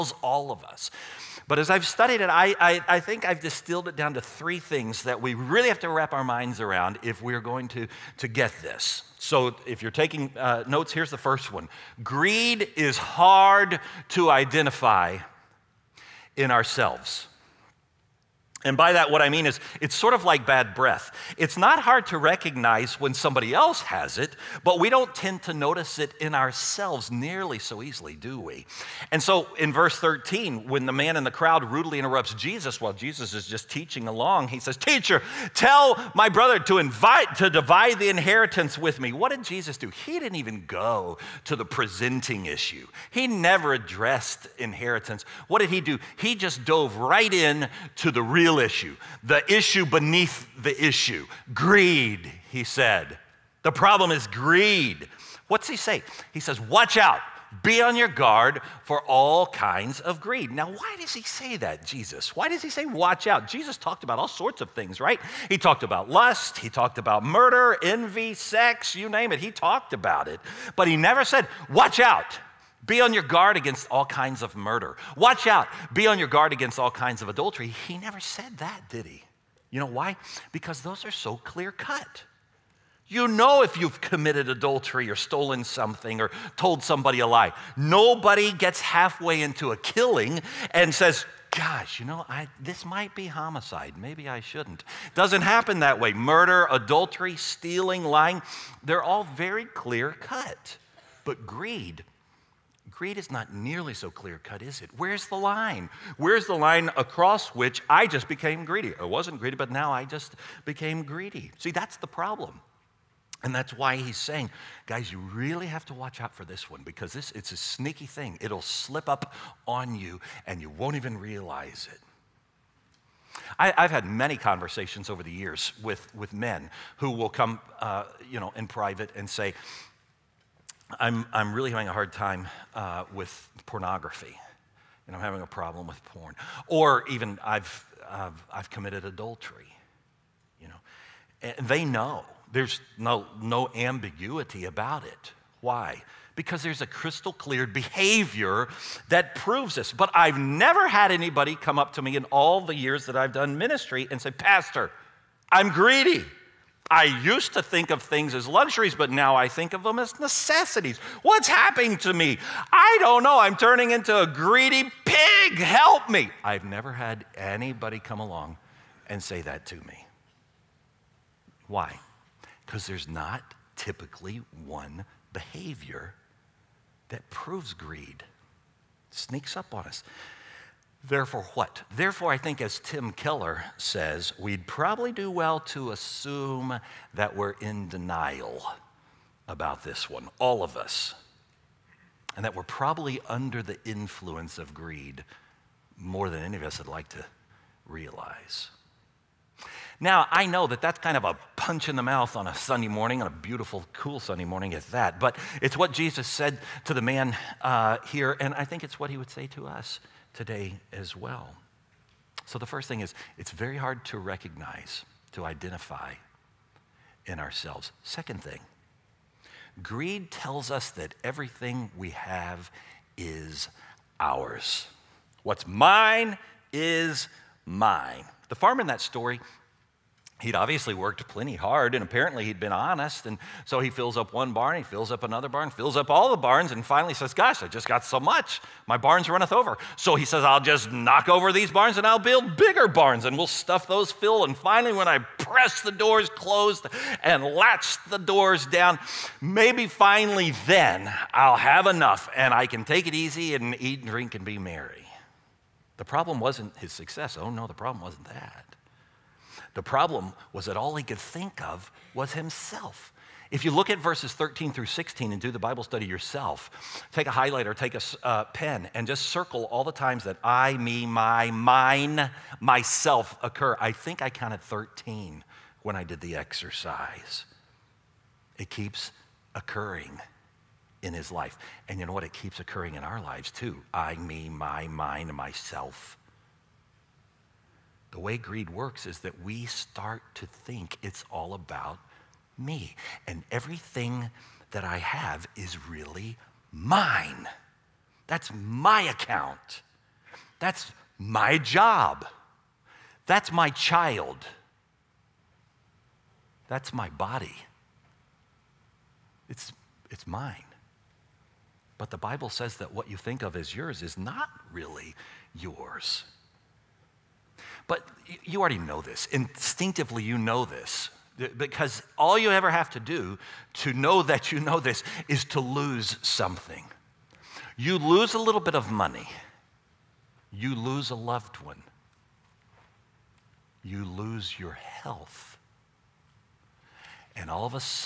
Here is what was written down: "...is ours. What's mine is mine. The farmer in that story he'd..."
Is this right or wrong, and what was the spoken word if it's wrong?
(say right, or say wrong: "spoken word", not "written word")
right.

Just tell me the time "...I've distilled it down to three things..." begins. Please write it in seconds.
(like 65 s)
3 s.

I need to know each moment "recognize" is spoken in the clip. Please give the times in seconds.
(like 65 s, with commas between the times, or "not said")
22 s, 214 s.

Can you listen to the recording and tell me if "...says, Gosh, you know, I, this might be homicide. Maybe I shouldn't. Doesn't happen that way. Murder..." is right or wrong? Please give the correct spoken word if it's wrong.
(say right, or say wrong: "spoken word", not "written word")
right.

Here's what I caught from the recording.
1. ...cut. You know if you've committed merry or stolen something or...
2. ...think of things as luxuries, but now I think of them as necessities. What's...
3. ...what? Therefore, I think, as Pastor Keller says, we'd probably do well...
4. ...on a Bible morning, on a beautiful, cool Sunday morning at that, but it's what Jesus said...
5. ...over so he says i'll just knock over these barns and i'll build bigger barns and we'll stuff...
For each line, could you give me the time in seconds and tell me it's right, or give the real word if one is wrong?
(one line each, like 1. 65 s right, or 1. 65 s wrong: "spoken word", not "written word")
1. 81 s wrong: "adultery", not "merry"
2. 157 s right
3. 181 s wrong: "Tim", not "Pastor"
4. 202 s wrong: "Sunday", not "Bible"
5. 239 s right.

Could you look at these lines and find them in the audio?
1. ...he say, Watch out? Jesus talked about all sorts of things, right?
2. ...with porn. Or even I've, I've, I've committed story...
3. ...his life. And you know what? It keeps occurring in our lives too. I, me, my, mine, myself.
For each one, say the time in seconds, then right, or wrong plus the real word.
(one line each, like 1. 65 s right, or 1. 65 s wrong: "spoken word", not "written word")
1. 62 s right
2. 135 s wrong: "adultery", not "story"
3. 281 s right.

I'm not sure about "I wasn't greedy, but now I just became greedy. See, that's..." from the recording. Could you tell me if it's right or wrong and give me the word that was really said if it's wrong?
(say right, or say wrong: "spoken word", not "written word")
right.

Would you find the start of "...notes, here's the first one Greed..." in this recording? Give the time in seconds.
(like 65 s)
10 s.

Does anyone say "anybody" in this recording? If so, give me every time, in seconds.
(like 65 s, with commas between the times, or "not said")
151 s, 167 s.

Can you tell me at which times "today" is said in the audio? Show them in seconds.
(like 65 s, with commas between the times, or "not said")
210 s.